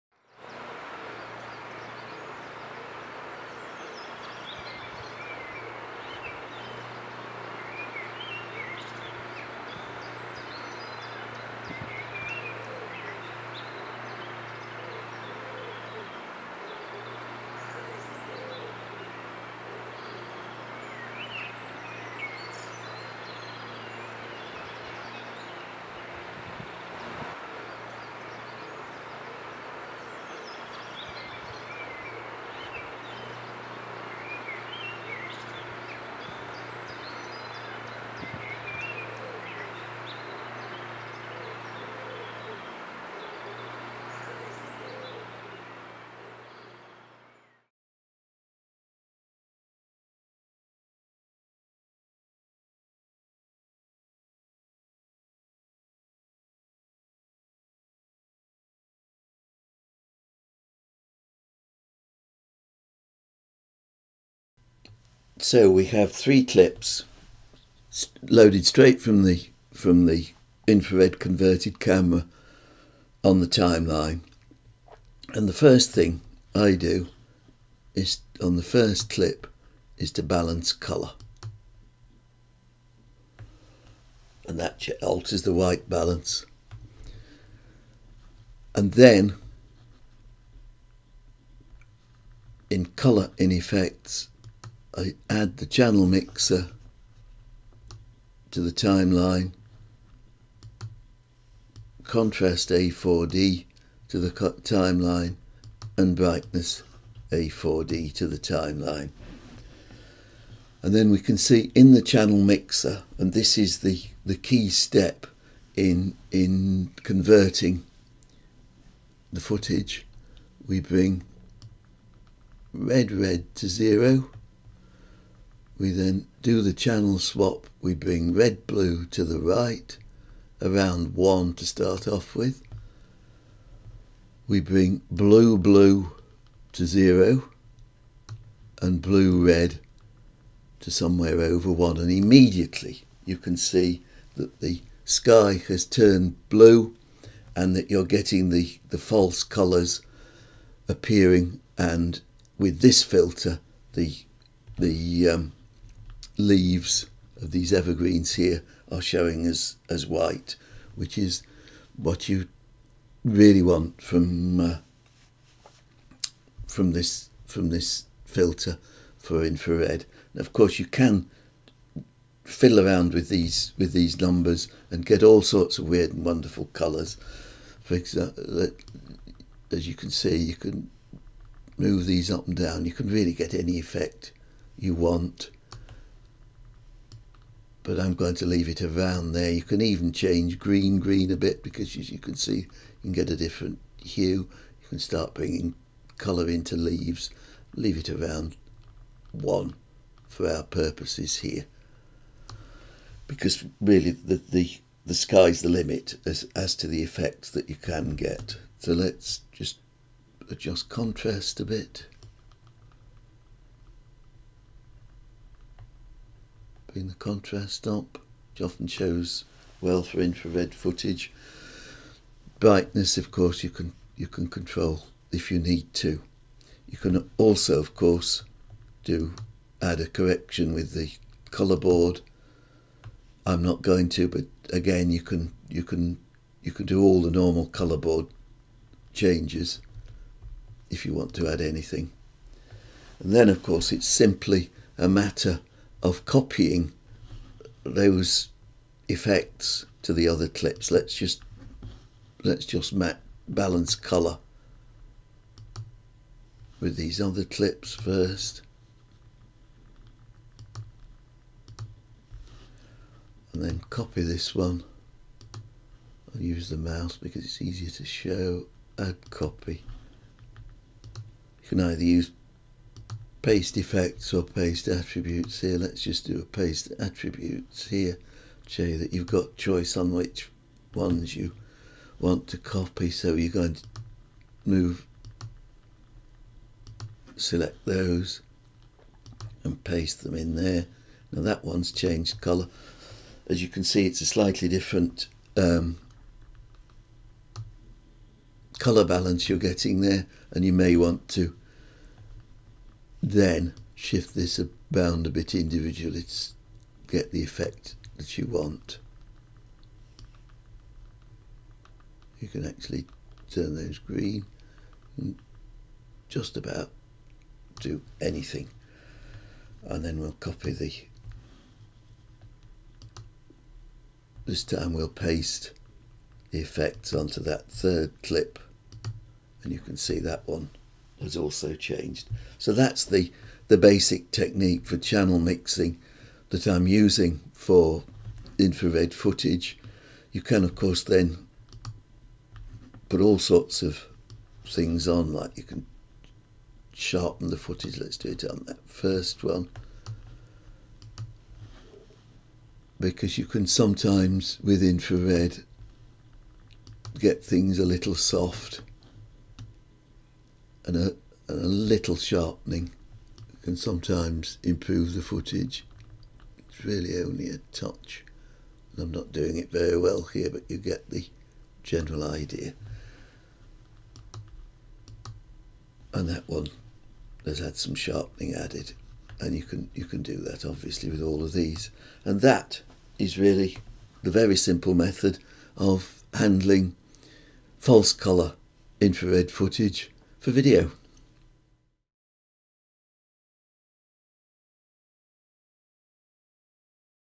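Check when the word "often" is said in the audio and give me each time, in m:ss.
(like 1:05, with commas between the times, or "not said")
3:38.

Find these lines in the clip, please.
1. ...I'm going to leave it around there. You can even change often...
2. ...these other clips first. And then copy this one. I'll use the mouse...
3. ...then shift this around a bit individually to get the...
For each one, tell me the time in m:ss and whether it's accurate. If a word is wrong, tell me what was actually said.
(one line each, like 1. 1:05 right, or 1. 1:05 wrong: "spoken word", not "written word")
1. 3:07 wrong: "green", not "often"
2. 4:16 right
3. 5:03 right.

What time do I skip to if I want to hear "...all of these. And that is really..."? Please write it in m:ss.
6:21.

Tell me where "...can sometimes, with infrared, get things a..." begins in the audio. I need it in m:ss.
5:53.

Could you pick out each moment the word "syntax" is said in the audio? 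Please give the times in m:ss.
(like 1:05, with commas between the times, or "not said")
not said.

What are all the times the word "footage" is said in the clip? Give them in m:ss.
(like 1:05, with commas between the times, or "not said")
1:59, 3:40, 5:39, 5:47, 6:05, 6:29.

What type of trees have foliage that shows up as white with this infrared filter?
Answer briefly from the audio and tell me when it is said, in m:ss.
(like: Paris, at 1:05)
evergreens, at 2:37.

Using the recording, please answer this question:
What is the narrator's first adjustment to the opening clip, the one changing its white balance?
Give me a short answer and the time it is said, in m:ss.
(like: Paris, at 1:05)
balance colour, at 1:20.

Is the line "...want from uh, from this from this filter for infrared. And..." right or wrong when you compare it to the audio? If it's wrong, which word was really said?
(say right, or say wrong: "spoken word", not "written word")
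right.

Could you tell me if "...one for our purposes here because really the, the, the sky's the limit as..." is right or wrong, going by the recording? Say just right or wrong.
right.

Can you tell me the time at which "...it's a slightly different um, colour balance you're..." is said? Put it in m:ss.
4:54.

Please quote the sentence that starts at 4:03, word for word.
And then, of course, it's simply a matter of copying those effects to the other clips.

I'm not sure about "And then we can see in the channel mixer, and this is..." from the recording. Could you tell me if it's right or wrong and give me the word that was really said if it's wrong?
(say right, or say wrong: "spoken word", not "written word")
right.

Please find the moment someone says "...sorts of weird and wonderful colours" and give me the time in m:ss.
2:55.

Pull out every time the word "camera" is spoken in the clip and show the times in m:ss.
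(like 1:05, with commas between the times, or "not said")
1:11.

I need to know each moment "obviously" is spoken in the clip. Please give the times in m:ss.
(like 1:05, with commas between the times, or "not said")
6:20.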